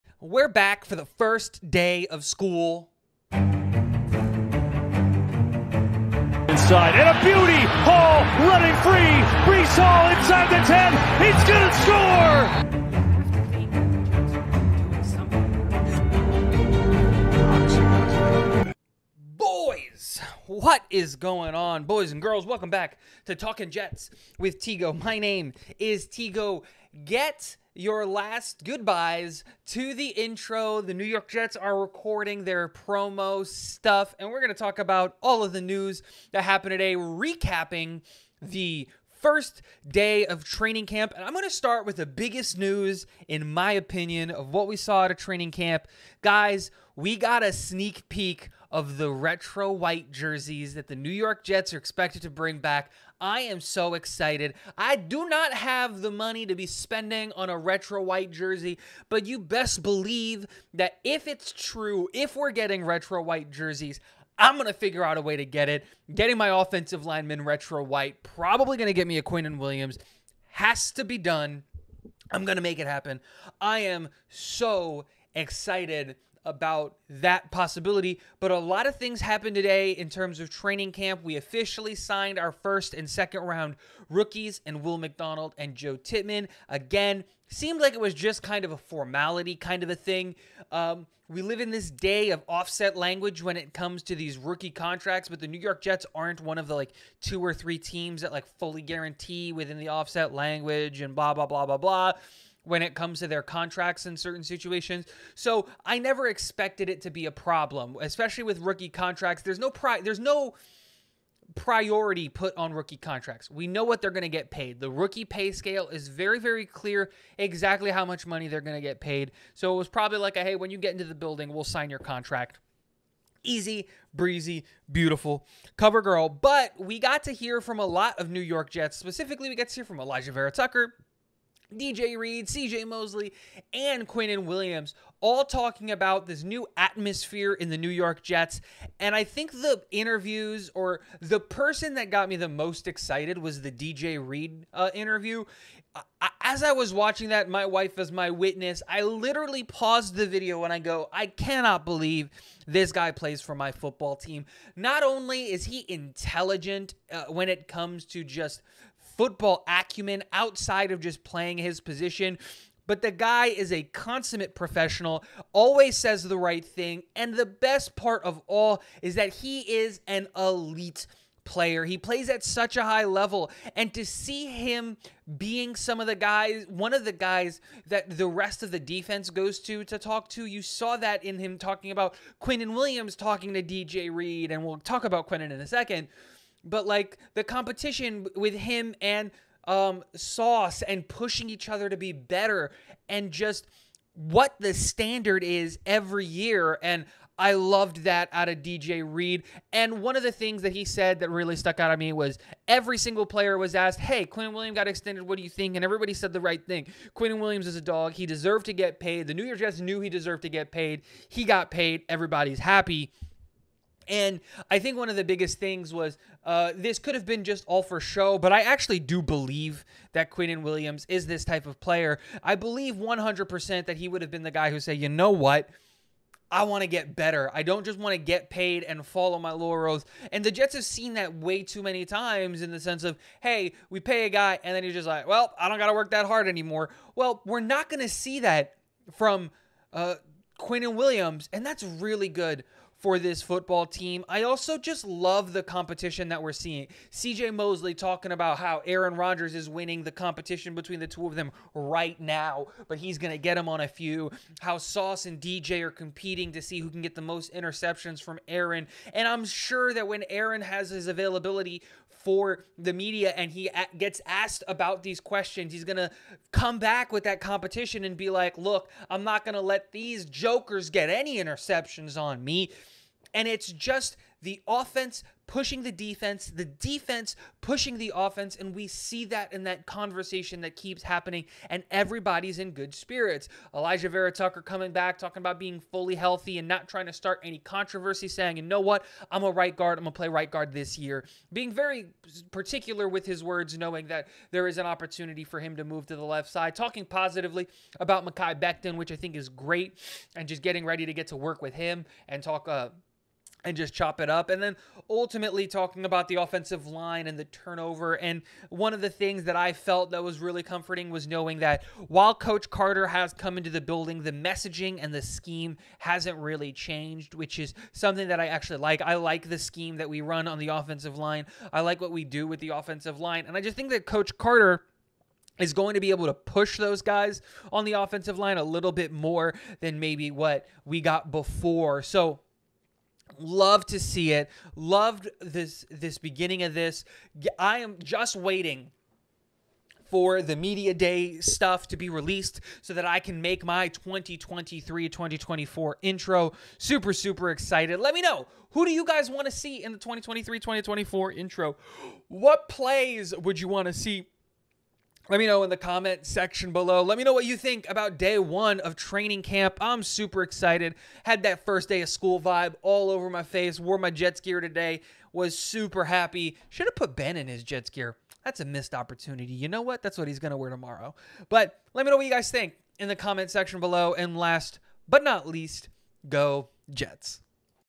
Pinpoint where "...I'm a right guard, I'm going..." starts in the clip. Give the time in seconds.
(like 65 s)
289 s.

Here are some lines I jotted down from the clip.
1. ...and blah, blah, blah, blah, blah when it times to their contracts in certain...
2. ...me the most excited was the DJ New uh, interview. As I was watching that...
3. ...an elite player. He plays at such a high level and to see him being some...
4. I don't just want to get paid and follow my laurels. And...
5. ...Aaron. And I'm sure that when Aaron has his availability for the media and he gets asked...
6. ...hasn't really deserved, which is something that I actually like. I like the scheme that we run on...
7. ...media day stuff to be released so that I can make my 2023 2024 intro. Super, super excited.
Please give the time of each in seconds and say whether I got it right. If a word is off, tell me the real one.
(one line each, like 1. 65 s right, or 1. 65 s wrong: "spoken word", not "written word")
1. 100 s wrong: "comes", not "times"
2. 142 s wrong: "Reed", not "New"
3. 170 s right
4. 227 s right
5. 258 s right
6. 315 s wrong: "changed", not "deserved"
7. 340 s right.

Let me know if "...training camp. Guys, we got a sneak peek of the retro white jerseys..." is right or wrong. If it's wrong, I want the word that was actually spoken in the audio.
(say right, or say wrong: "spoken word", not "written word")
right.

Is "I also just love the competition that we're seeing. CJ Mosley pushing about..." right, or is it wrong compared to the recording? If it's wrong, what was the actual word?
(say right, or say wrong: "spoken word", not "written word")
wrong: "talking", not "pushing".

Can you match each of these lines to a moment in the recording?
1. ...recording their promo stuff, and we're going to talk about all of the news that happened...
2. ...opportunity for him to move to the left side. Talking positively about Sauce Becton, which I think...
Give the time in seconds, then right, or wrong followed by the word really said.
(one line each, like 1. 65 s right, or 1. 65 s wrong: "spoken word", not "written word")
1. 31 s right
2. 294 s wrong: "Mekhi", not "Sauce".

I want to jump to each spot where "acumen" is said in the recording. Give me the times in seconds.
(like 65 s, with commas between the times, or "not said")
159 s.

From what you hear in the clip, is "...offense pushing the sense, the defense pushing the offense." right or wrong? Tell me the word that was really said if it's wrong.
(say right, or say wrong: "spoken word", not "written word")
wrong: "defense", not "sense".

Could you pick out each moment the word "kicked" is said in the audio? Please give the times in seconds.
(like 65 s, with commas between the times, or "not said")
not said.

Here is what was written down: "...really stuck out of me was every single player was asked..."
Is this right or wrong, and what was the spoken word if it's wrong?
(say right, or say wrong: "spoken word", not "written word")
right.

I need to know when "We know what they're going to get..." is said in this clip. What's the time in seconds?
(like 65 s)
113 s.